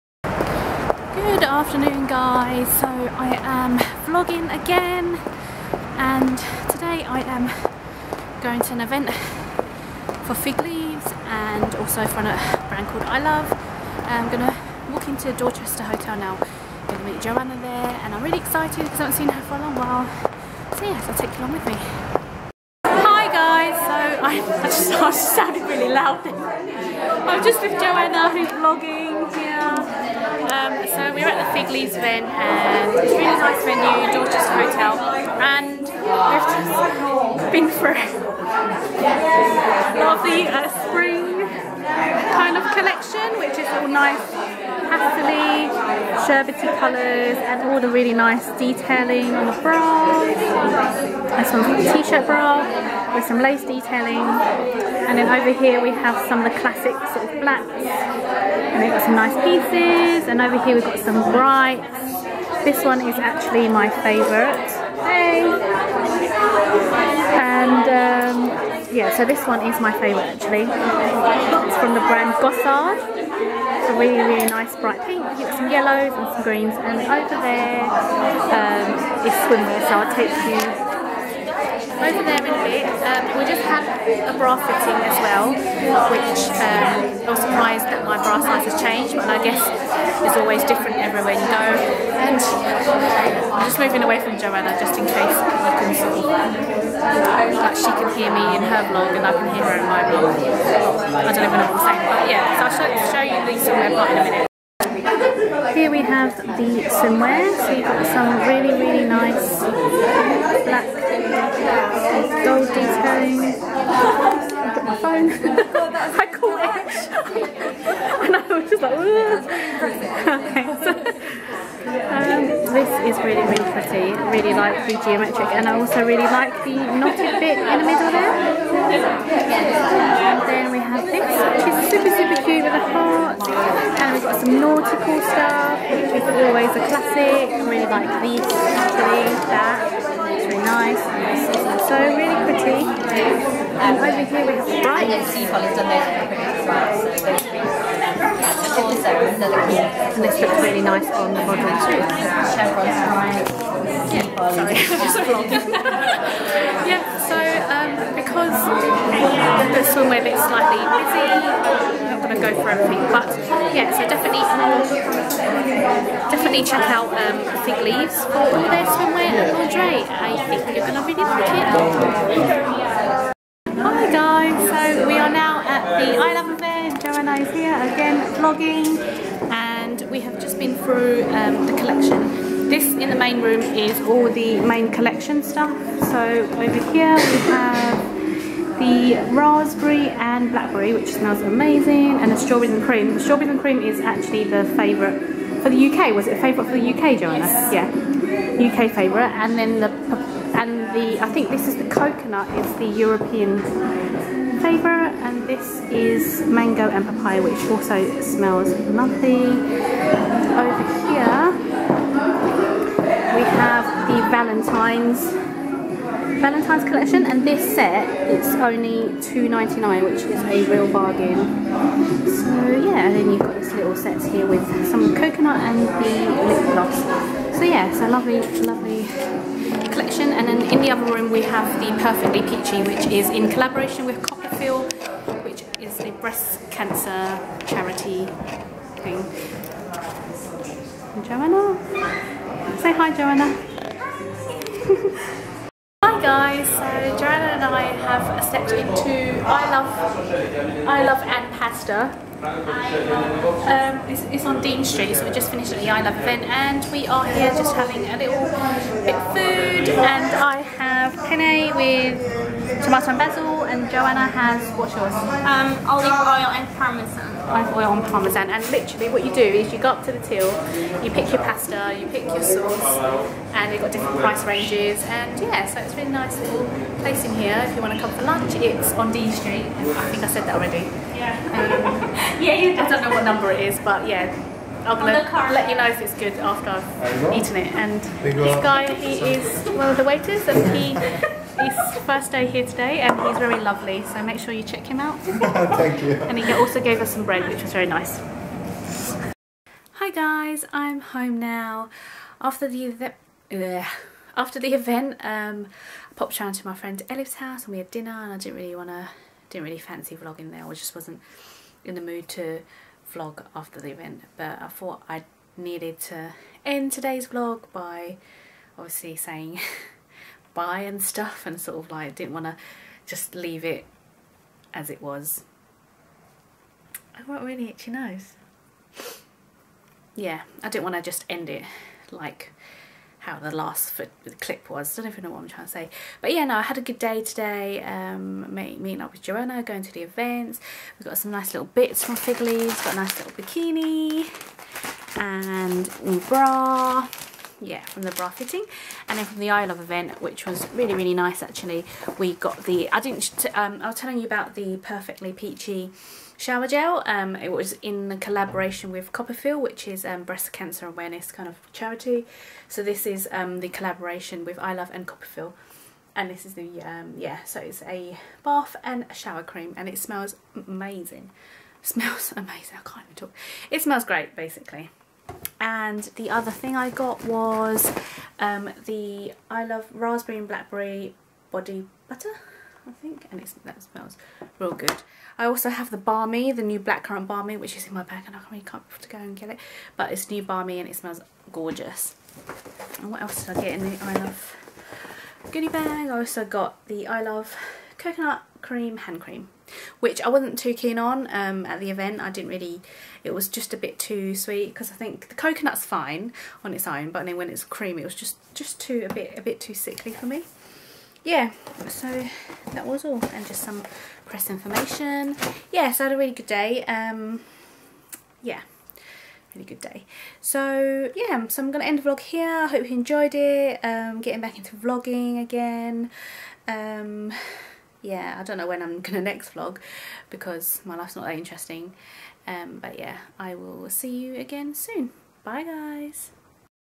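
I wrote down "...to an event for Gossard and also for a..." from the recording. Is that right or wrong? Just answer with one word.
wrong.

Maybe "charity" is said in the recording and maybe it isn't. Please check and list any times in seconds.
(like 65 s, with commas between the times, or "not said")
237 s, 361 s.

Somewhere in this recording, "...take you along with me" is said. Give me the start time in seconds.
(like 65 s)
21 s.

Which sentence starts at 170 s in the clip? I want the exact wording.
I think you're going to really like it.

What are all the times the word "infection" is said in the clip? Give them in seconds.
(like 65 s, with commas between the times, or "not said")
not said.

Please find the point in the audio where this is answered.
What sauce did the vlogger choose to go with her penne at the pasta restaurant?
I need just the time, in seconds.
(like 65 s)
262 s.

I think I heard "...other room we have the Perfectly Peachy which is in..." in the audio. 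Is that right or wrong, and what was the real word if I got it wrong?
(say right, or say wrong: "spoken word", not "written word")
right.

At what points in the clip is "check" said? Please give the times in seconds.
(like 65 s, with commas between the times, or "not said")
166 s, 294 s.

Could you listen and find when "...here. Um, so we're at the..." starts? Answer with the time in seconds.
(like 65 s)
29 s.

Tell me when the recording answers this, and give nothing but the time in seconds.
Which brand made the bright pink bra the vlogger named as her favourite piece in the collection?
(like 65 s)
72 s.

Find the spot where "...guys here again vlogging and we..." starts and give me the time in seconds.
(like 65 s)
177 s.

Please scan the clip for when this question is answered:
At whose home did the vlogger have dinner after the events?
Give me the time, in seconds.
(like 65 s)
307 s.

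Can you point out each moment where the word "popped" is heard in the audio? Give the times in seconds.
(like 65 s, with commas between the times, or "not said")
306 s.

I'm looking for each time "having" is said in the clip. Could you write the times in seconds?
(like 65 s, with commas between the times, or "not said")
257 s.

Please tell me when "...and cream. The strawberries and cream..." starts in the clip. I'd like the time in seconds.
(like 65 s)
192 s.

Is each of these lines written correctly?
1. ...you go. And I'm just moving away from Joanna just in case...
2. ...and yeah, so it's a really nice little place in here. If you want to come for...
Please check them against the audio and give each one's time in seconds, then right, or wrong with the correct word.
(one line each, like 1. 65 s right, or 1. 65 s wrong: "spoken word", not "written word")
1. 91 s right
2. 275 s right.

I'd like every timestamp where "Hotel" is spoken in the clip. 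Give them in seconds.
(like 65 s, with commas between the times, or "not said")
15 s, 34 s.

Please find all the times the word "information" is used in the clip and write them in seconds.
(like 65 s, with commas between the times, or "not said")
414 s.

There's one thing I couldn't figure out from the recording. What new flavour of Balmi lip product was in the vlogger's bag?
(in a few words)
Blackcurrant.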